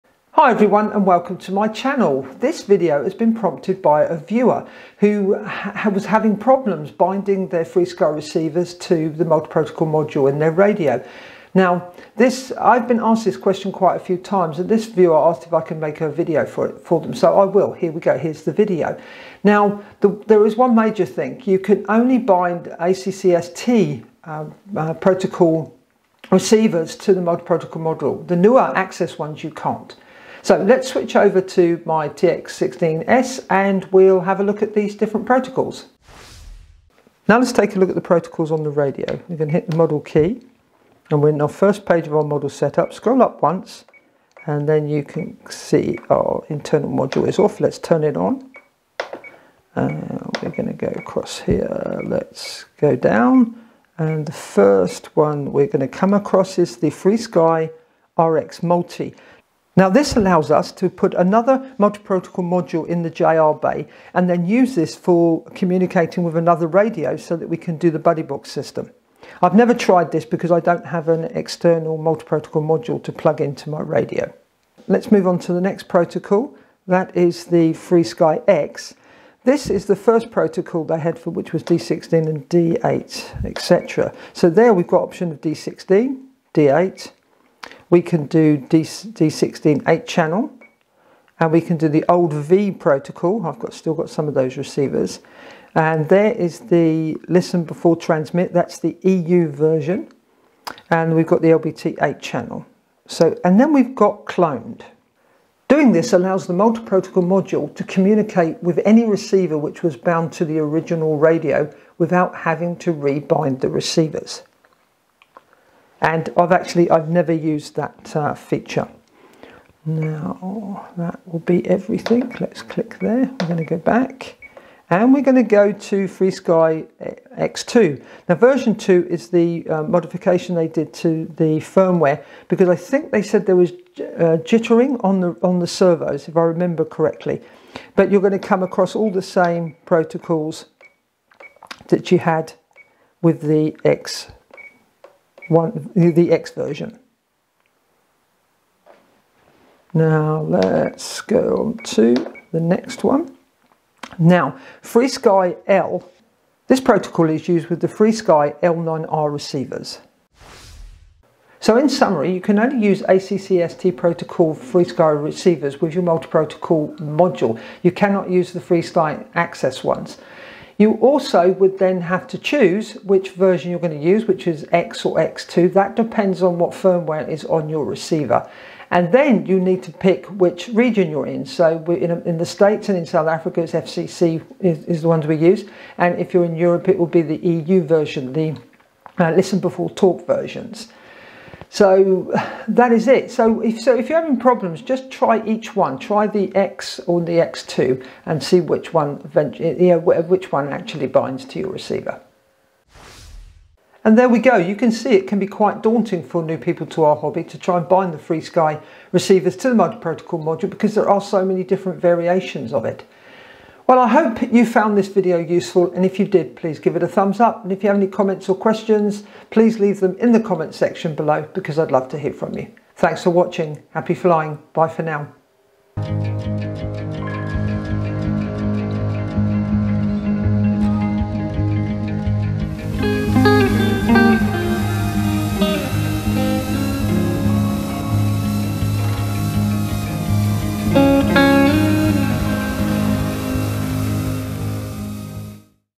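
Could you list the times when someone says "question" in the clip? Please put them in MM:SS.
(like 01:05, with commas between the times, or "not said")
00:13, 03:38.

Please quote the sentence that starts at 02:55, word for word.
That depends on what firmware is on your receiver.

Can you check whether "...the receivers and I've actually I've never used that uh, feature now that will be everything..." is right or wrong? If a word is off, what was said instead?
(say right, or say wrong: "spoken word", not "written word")
right.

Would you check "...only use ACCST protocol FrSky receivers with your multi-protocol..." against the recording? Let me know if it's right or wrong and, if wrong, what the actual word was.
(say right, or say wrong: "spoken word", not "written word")
right.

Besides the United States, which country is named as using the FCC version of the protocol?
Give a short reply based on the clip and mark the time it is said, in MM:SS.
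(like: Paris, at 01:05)
South Africa, at 03:03.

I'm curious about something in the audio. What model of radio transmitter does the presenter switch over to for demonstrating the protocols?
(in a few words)
TX16S.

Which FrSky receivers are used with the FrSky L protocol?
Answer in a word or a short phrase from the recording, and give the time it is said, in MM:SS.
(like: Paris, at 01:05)
L9R, at 02:38.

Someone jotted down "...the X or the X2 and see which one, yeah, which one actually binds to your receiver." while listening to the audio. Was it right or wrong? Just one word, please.
right.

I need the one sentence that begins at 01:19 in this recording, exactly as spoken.
This is the first protocol they had for which was D16 and D8, etc.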